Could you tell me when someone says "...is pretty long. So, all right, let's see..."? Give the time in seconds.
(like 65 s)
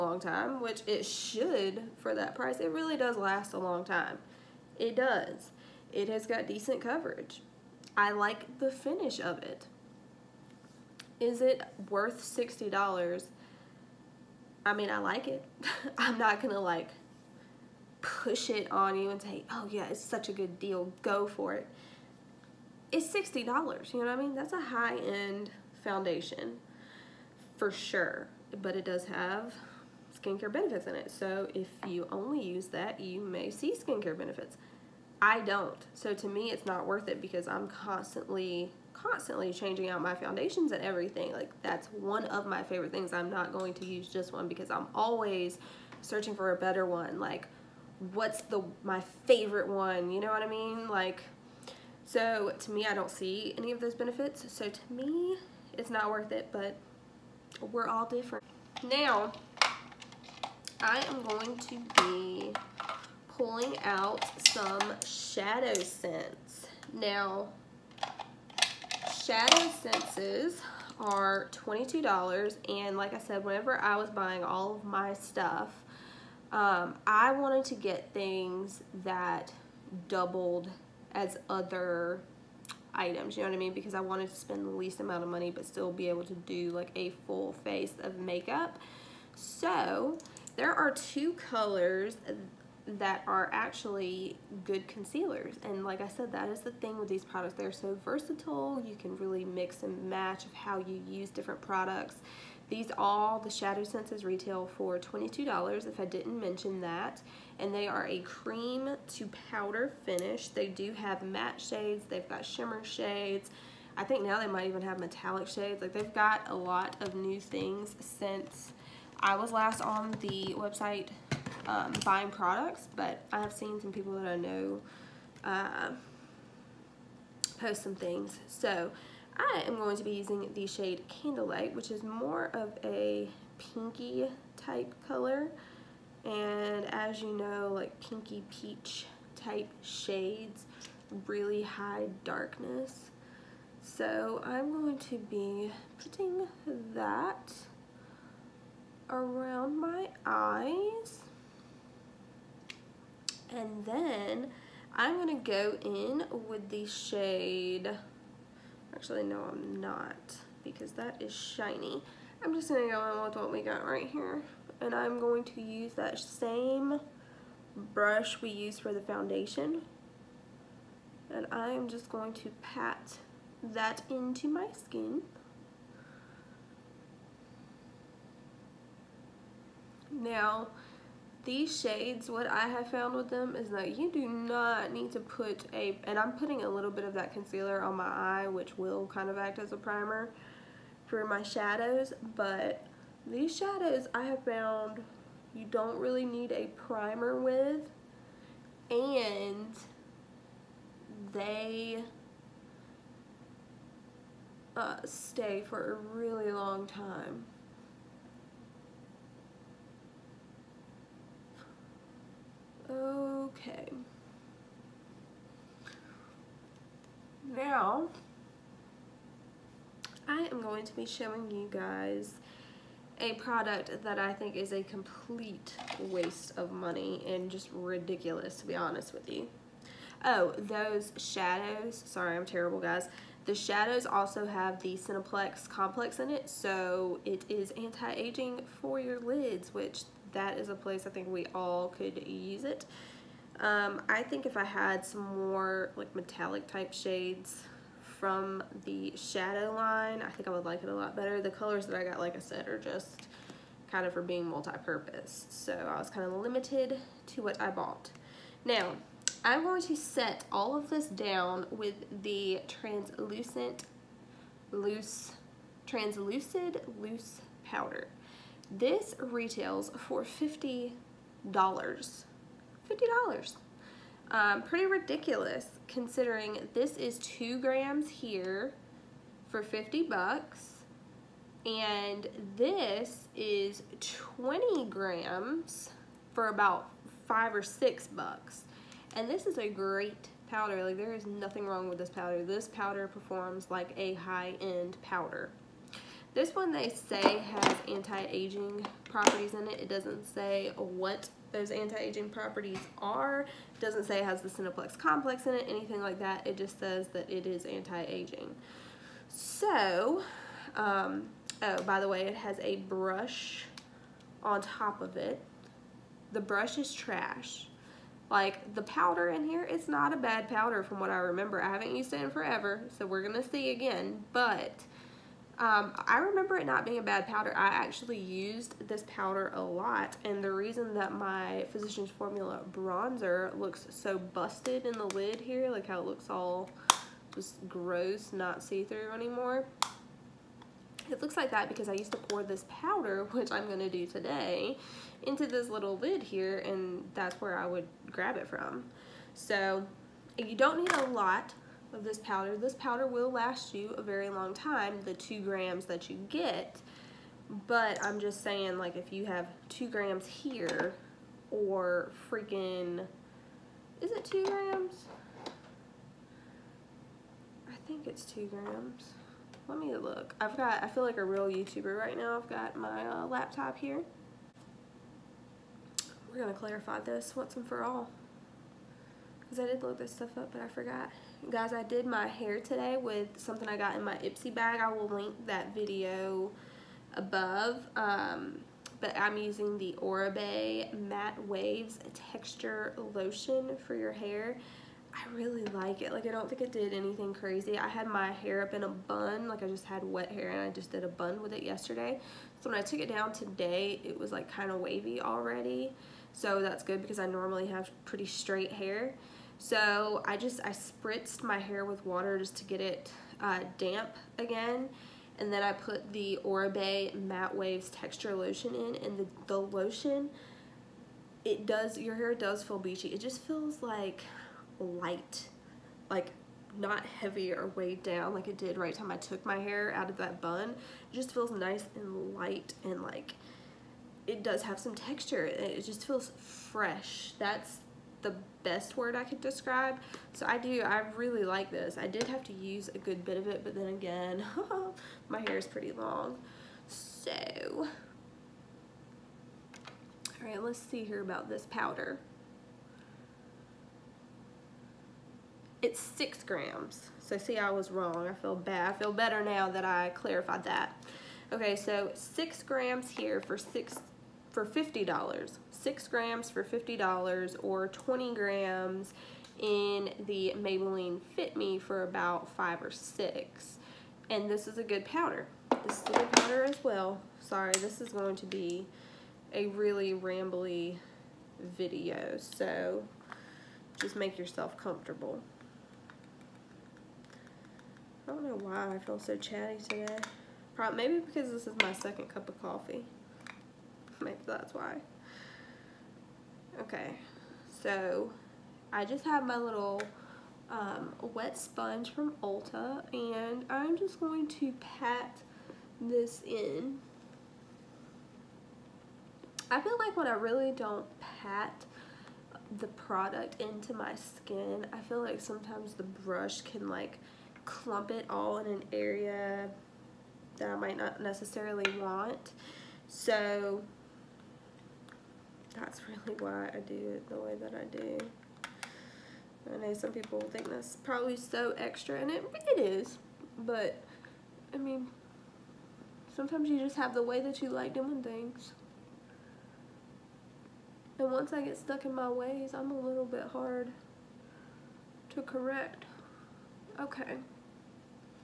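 445 s.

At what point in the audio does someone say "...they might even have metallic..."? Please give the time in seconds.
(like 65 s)
114 s.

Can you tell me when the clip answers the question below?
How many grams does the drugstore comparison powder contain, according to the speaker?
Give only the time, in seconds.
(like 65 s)
284 s.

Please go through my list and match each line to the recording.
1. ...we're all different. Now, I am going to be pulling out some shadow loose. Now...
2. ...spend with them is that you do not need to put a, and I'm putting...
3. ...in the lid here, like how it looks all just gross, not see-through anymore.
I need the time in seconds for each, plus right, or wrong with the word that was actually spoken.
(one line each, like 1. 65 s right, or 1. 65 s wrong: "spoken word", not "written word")
1. 57 s wrong: "sense", not "loose"
2. 182 s wrong: "found", not "spend"
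3. 334 s right.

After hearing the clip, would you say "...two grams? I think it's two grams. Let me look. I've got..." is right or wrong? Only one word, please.
right.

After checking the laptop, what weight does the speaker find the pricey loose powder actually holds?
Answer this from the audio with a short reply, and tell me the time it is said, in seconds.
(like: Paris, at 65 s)
6 grams, at 455 s.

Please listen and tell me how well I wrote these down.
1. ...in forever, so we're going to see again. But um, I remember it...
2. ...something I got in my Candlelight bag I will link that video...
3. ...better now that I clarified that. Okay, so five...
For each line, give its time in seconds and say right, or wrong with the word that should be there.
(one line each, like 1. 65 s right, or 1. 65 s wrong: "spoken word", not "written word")
1. 322 s right
2. 383 s wrong: "Ipsy", not "Candlelight"
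3. 459 s wrong: "six", not "five".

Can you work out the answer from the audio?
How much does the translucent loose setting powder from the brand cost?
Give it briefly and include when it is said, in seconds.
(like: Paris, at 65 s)
$50, at 268 s.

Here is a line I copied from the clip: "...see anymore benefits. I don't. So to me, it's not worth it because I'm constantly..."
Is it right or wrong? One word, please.
wrong.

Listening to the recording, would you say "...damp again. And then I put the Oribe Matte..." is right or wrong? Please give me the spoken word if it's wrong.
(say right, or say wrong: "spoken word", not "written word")
right.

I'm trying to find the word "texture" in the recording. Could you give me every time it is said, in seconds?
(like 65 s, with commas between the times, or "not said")
392 s, 417 s, 434 s.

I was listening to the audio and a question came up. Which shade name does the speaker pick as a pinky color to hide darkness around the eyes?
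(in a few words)
Candlelight.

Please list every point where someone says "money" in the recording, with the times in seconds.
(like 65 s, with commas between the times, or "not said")
85 s, 226 s.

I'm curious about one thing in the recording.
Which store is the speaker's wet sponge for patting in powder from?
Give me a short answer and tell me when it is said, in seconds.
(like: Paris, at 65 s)
Ulta, at 502 s.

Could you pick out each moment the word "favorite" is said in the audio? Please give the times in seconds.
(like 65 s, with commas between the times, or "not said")
42 s, 49 s.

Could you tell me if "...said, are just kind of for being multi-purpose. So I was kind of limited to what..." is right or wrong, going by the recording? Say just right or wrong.
right.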